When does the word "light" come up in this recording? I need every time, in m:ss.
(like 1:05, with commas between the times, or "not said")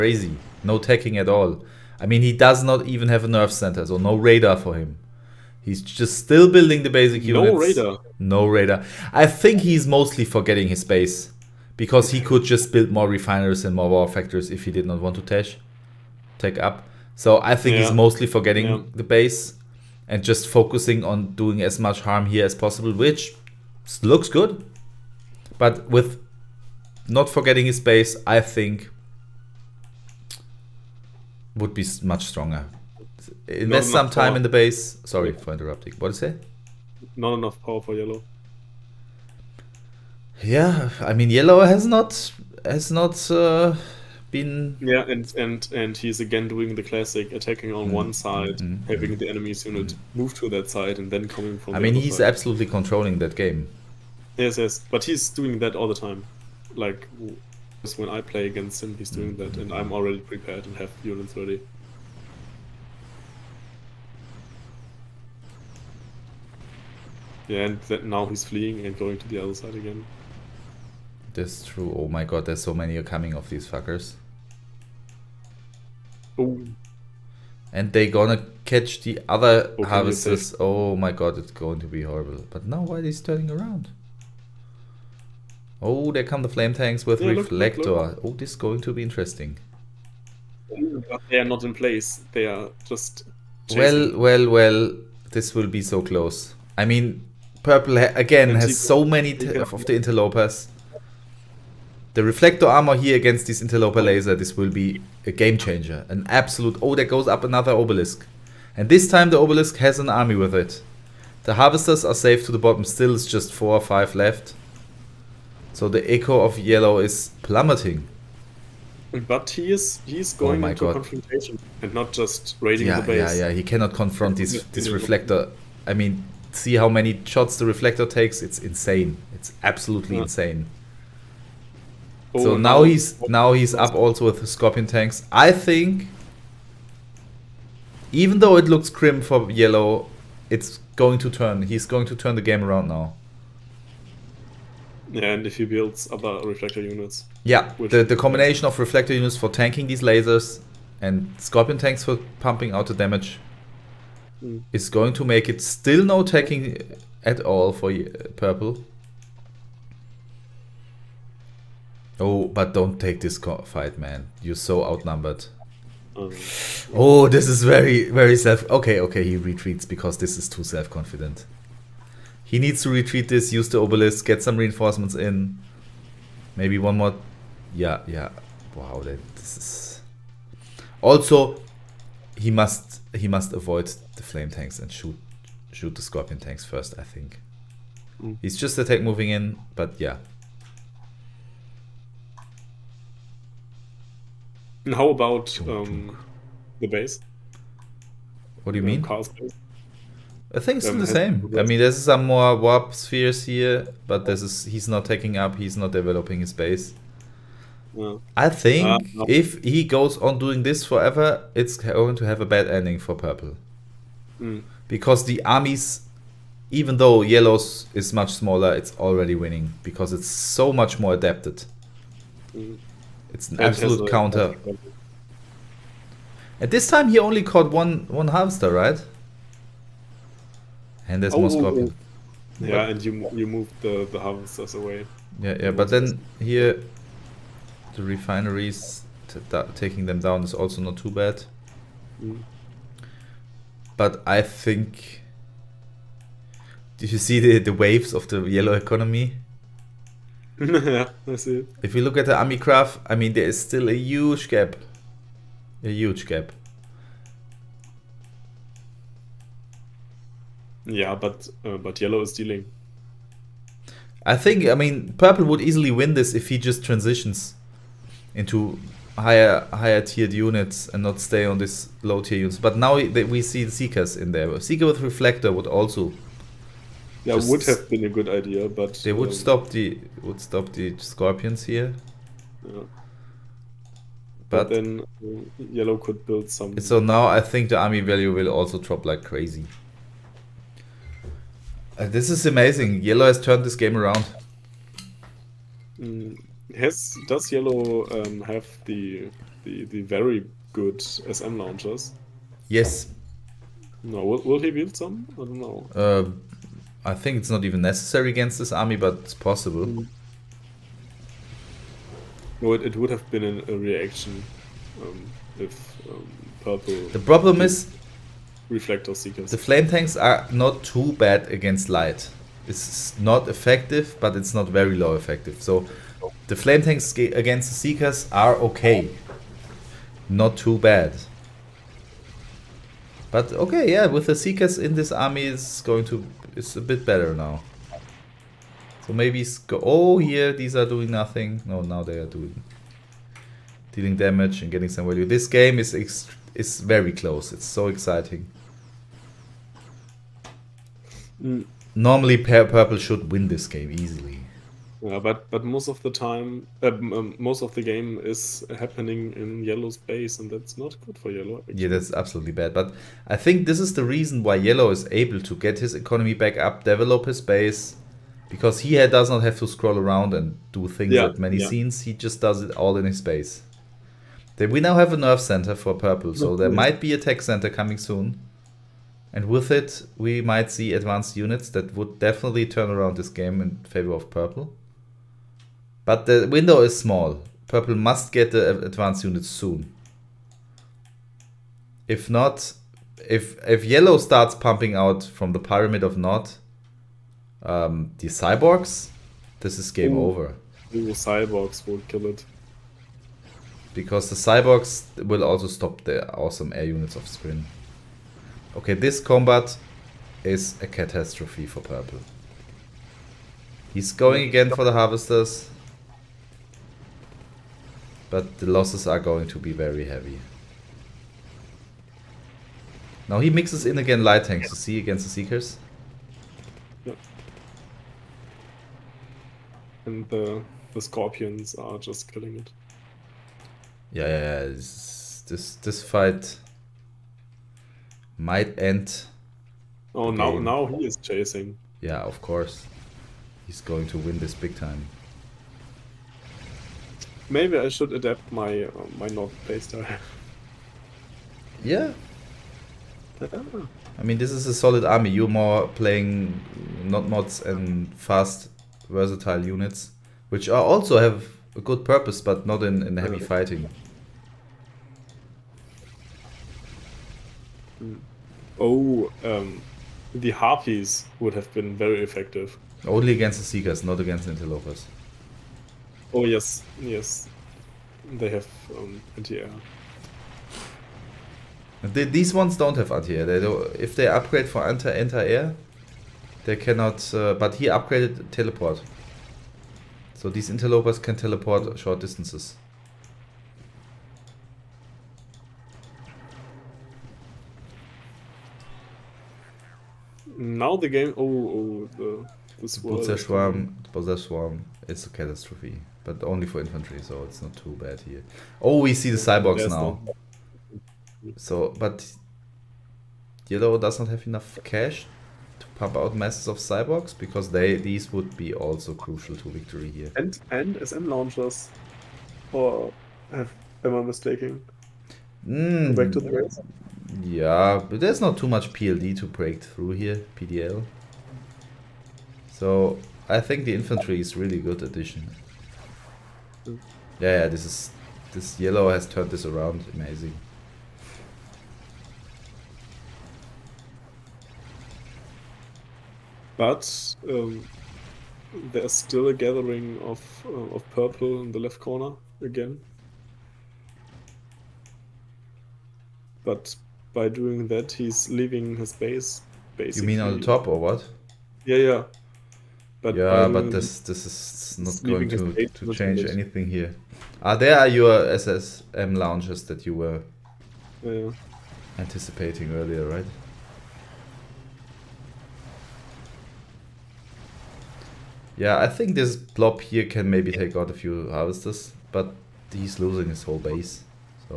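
5:21, 7:04.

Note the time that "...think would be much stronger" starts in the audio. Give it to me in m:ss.
0:28.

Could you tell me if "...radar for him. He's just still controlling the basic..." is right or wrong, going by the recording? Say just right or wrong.
wrong.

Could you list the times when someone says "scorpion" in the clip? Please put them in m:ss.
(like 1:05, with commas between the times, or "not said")
2:14, 2:31, 3:06, 3:51, 4:40, 7:11.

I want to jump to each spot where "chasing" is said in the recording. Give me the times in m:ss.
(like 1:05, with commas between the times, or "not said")
1:33, 7:21.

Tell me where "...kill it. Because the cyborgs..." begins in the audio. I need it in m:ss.
6:42.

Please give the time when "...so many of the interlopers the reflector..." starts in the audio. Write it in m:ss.
1:38.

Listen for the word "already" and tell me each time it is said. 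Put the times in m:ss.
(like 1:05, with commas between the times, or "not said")
0:59, 3:38.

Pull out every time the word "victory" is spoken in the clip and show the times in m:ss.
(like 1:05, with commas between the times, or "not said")
8:39.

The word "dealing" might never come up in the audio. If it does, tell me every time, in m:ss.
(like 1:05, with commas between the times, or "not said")
4:22, 5:43.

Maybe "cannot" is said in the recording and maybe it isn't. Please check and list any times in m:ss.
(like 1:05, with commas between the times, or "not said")
2:03, 8:06.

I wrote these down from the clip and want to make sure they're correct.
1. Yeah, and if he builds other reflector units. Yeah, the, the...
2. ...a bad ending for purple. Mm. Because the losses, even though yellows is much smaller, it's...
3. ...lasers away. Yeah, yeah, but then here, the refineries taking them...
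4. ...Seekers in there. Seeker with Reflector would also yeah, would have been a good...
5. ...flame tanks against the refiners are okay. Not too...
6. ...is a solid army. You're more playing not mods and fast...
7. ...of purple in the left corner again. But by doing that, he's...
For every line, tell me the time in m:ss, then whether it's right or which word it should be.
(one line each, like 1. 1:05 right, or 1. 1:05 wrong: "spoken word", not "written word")
1. 2:25 right
2. 3:32 wrong: "armies", not "losses"
3. 3:54 wrong: "harvesters", not "lasers"
4. 4:33 right
5. 5:26 wrong: "seekers", not "refiners"
6. 7:34 right
7. 9:10 right.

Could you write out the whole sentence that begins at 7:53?
Only against the seekers, not against interlopers.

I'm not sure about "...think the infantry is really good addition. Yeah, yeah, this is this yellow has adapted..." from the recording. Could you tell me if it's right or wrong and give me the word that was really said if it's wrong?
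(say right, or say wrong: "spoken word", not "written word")
wrong: "turned", not "adapted".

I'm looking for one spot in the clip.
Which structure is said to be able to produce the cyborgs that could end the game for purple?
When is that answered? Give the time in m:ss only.
6:35.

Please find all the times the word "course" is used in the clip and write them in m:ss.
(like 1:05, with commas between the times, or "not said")
7:22.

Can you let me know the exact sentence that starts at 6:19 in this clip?
And with it, we might see advanced units that would definitely turn around this game in favor of purple.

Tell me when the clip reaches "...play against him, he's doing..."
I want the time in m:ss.
0:58.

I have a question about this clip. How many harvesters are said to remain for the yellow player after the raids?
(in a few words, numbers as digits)
4 or 5.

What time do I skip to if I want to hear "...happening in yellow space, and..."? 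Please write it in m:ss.
5:58.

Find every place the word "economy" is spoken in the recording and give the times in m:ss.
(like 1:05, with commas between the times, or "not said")
4:08, 6:05.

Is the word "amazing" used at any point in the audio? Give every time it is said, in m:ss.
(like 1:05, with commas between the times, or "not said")
4:52, 9:00.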